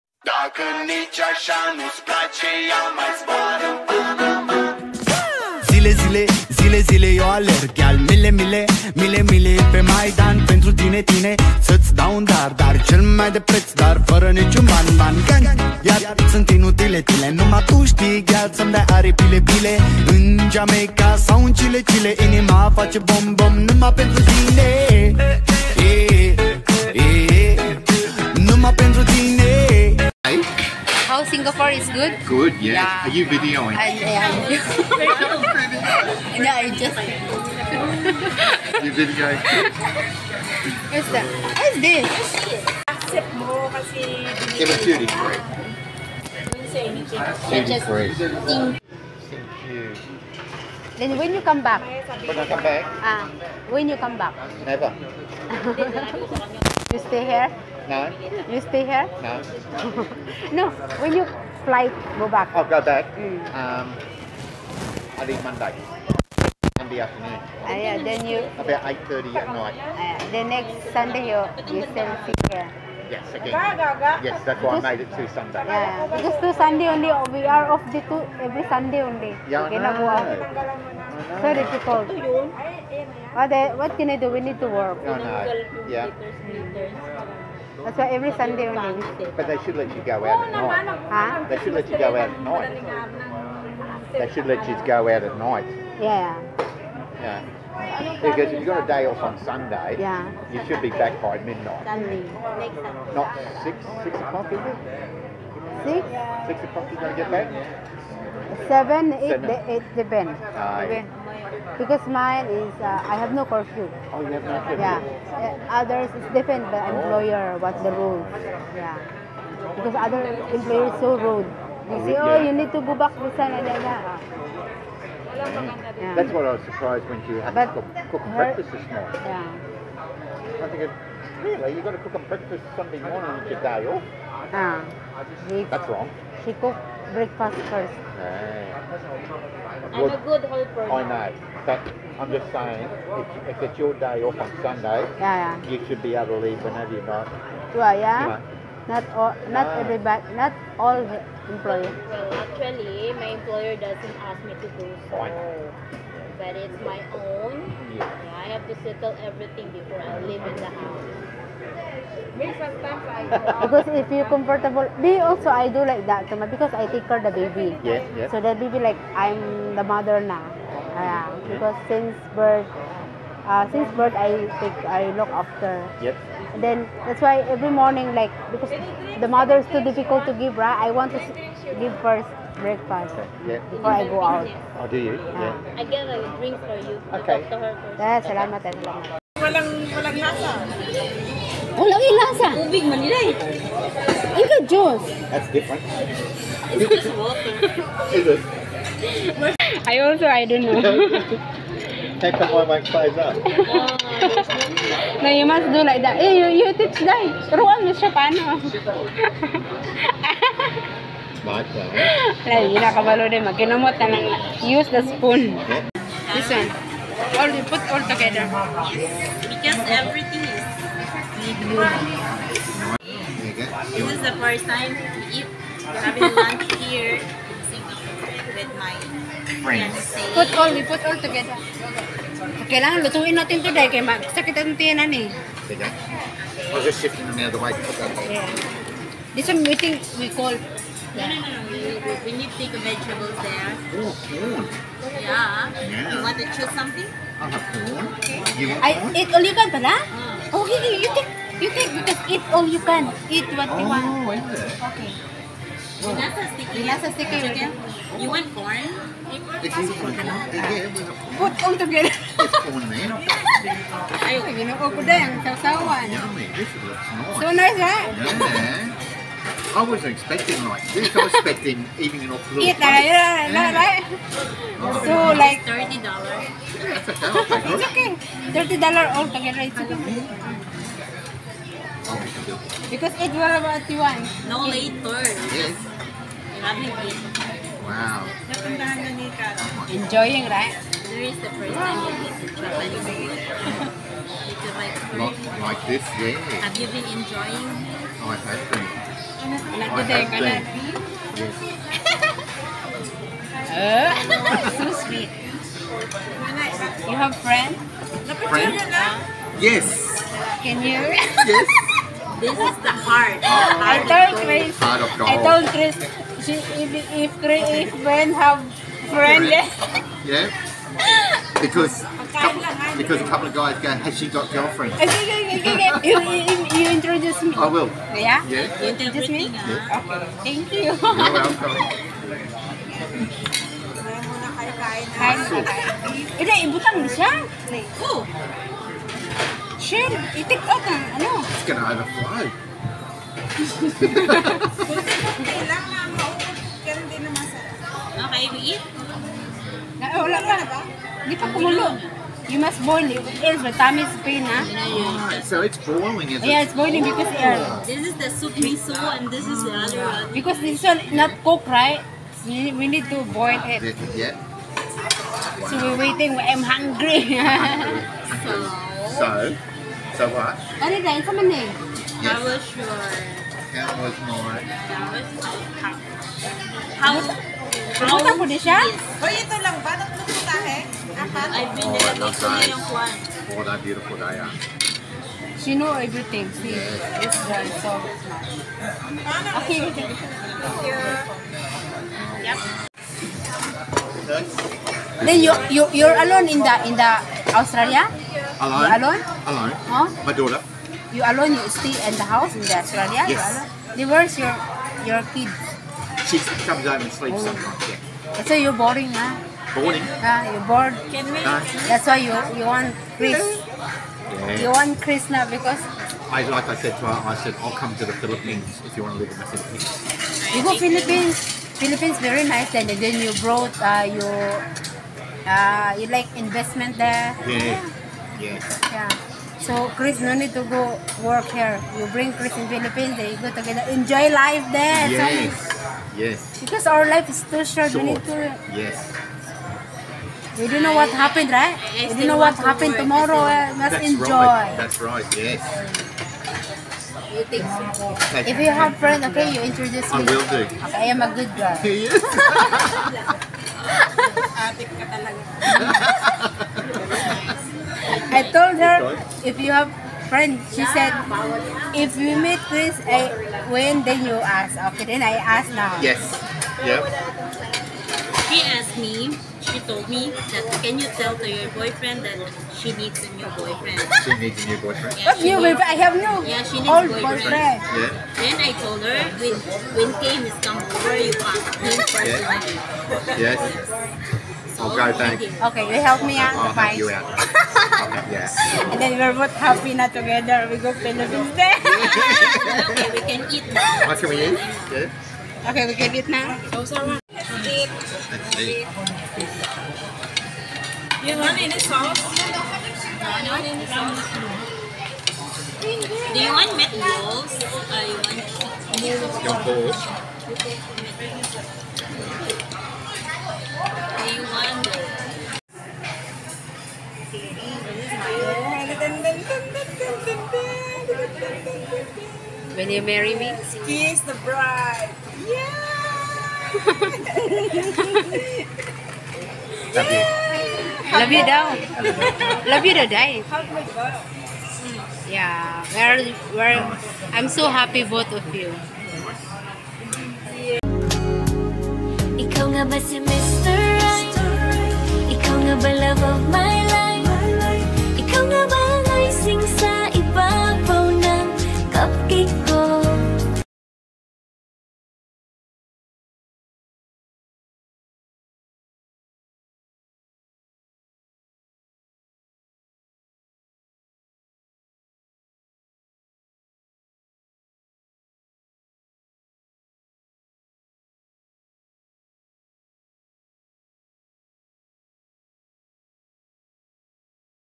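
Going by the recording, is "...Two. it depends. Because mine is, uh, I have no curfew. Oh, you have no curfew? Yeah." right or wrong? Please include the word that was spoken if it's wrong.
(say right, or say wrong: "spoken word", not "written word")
wrong: "Seven", not "Two".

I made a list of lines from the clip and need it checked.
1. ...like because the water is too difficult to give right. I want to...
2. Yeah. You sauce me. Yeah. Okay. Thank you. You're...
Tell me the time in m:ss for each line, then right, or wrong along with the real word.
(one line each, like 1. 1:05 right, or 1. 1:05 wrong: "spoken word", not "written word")
1. 2:58 wrong: "mother", not "water"
2. 5:28 wrong: "introduce", not "sauce".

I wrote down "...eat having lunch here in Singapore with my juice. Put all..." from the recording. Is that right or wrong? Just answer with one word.
wrong.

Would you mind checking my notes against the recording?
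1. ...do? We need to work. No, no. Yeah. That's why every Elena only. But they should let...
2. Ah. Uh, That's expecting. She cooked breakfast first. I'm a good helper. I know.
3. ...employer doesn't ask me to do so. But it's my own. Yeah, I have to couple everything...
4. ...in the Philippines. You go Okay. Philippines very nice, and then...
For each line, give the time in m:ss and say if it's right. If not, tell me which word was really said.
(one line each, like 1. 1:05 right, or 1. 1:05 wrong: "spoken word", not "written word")
1. 1:24 wrong: "Sunday", not "Elena"
2. 2:14 wrong: "wrong", not "expecting"
3. 2:33 wrong: "settle", not "couple"
4. 6:59 wrong: "Philippines", not "Okay".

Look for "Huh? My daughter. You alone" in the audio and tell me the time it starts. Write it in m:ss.
6:39.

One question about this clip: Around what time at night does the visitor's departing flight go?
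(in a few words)
8.30.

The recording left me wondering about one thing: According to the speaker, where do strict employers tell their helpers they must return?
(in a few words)
San Elena.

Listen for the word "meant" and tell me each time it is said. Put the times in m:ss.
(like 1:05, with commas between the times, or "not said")
not said.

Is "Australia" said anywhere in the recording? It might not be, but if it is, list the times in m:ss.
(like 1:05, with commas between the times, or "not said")
6:37, 6:42.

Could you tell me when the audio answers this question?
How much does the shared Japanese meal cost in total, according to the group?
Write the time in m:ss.
4:38.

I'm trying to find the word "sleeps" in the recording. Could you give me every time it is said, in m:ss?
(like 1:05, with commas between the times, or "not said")
6:47.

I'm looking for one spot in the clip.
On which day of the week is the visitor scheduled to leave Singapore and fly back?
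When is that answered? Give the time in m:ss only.
1:05.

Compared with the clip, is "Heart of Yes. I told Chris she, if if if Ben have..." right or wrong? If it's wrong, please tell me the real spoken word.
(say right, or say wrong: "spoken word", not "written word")
wrong: "God", not "Yes".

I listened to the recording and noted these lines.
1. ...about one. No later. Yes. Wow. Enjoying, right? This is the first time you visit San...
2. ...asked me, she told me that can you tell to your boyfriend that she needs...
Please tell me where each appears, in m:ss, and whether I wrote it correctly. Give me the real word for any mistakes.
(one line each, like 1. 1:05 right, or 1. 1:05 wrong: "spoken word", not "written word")
1. 4:43 wrong: "Japanese", not "San"
2. 7:48 right.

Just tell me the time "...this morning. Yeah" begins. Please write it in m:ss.
2:08.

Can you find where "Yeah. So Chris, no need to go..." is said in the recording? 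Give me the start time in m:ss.
7:08.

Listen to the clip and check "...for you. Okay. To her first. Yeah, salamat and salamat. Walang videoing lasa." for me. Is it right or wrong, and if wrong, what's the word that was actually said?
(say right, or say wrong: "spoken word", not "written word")
wrong: "walang", not "videoing".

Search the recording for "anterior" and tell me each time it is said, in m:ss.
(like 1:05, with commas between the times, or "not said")
not said.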